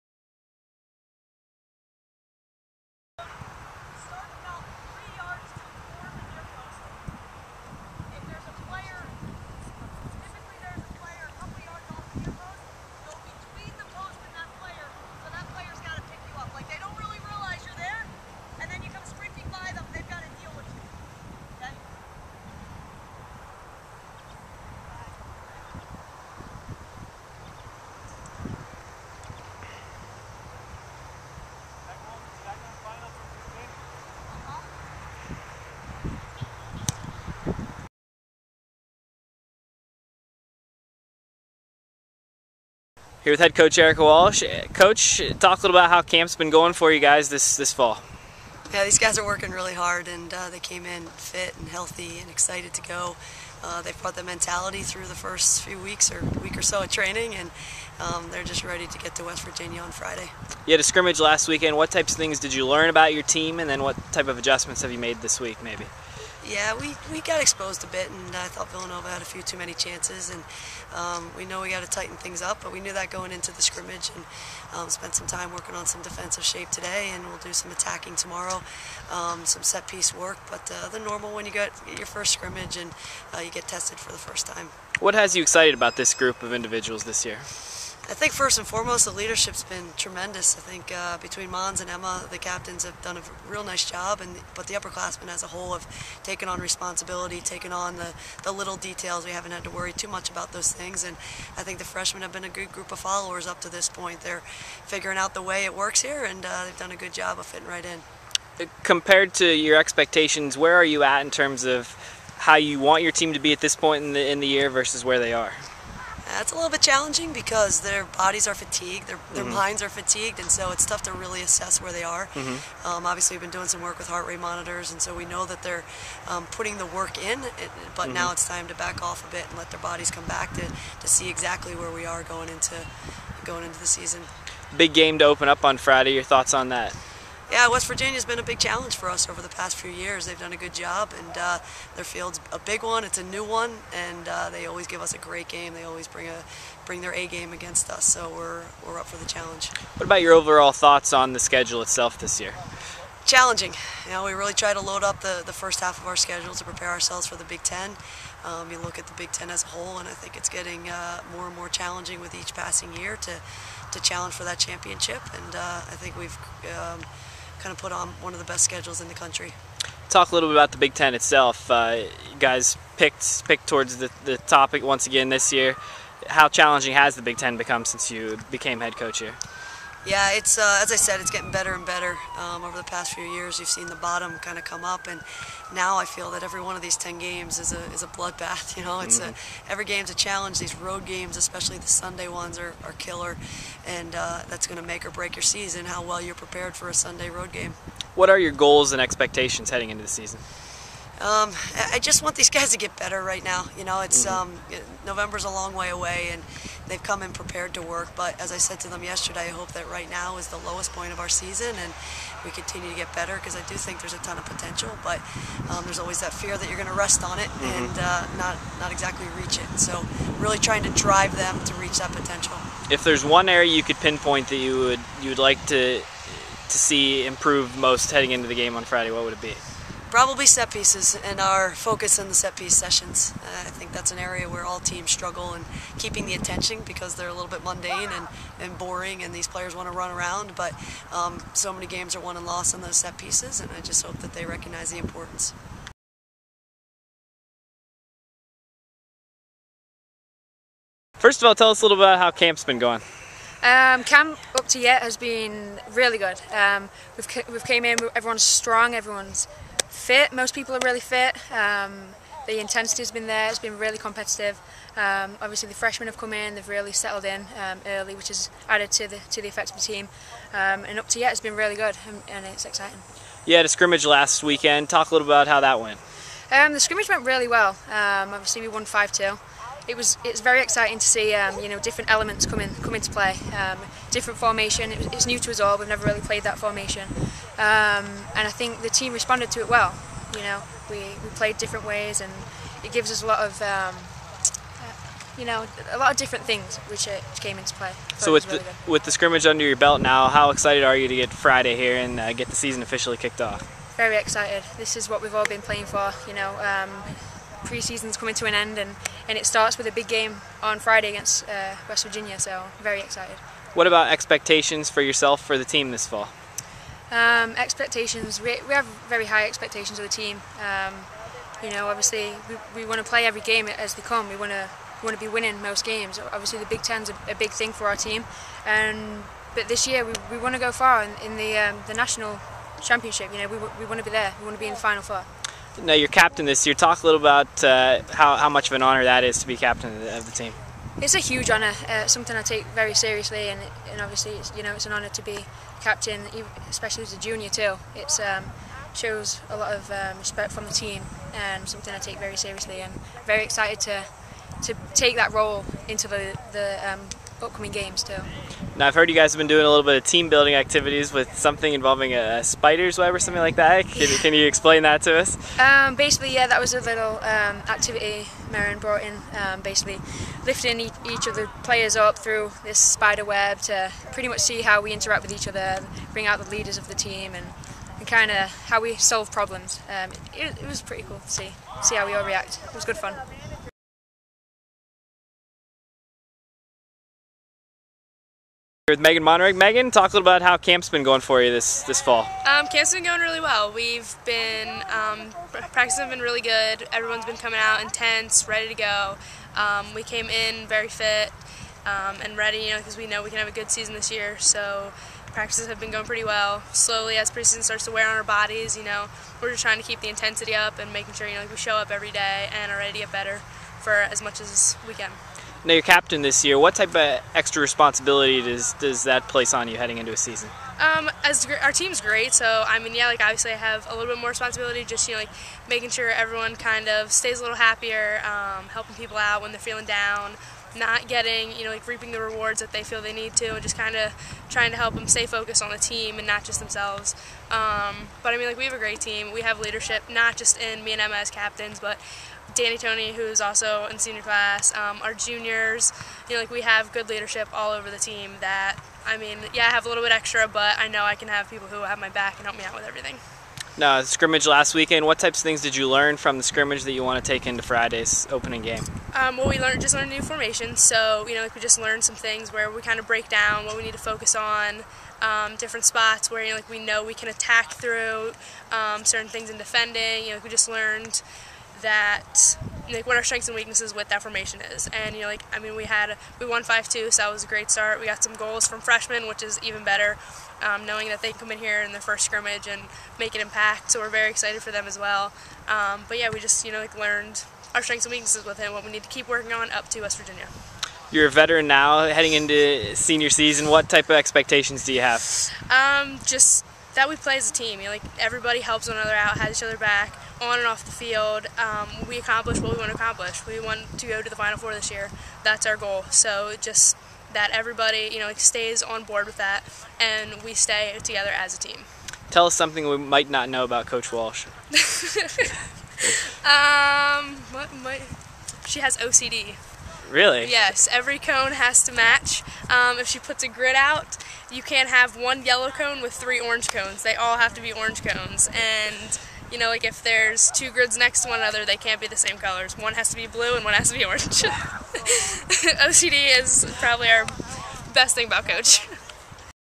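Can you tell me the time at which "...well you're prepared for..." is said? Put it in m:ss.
3:16.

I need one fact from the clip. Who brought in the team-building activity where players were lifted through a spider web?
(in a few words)
Marin.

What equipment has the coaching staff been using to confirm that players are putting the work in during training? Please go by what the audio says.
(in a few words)
heart rate monitors.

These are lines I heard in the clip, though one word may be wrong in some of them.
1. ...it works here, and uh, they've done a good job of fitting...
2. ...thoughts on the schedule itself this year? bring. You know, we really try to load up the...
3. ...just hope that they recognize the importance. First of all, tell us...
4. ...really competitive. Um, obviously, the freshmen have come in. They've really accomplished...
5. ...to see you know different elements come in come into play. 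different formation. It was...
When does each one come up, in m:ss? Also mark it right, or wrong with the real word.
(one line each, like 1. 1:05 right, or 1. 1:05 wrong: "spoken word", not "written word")
1. 1:45 right
2. 2:30 wrong: "challenging", not "bring"
3. 4:03 right
4. 4:23 wrong: "settled", not "accomplished"
5. 4:40 right.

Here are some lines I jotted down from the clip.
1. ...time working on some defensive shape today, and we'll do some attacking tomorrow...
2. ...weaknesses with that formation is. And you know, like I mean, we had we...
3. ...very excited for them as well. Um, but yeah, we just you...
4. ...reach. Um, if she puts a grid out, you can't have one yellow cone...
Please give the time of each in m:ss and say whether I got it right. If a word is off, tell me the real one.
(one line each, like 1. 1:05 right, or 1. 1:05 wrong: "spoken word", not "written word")
1. 1:15 right
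2. 7:53 right
3. 8:04 right
4. 8:41 wrong: "match", not "reach".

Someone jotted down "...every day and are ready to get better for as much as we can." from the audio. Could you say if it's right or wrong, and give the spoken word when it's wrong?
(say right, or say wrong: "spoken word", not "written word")
right.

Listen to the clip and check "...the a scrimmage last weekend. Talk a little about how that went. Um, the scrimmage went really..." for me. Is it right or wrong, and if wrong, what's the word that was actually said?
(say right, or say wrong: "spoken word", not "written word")
right.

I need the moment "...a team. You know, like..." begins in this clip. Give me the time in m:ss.
8:17.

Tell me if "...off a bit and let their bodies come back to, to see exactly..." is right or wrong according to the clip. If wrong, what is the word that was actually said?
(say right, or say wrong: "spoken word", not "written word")
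right.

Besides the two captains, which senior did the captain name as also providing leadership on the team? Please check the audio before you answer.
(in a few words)
Danny Tony.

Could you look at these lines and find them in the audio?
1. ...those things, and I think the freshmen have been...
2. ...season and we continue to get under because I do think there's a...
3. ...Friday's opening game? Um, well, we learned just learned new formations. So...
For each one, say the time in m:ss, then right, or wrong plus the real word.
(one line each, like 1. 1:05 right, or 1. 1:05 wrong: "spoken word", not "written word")
1. 1:40 right
2. 3:31 wrong: "better", not "under"
3. 7:37 right.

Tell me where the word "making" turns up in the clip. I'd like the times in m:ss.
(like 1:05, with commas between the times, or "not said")
6:50, 7:05.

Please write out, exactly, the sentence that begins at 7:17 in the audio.
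Um, but I mean, like we have a great team.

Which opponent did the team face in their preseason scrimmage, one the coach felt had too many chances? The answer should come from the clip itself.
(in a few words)
Villanova.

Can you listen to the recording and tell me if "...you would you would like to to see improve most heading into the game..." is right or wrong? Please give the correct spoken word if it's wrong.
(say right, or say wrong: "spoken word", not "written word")
right.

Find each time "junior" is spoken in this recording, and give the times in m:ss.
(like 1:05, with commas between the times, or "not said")
5:47, 7:25.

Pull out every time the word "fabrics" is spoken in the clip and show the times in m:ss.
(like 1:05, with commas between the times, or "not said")
not said.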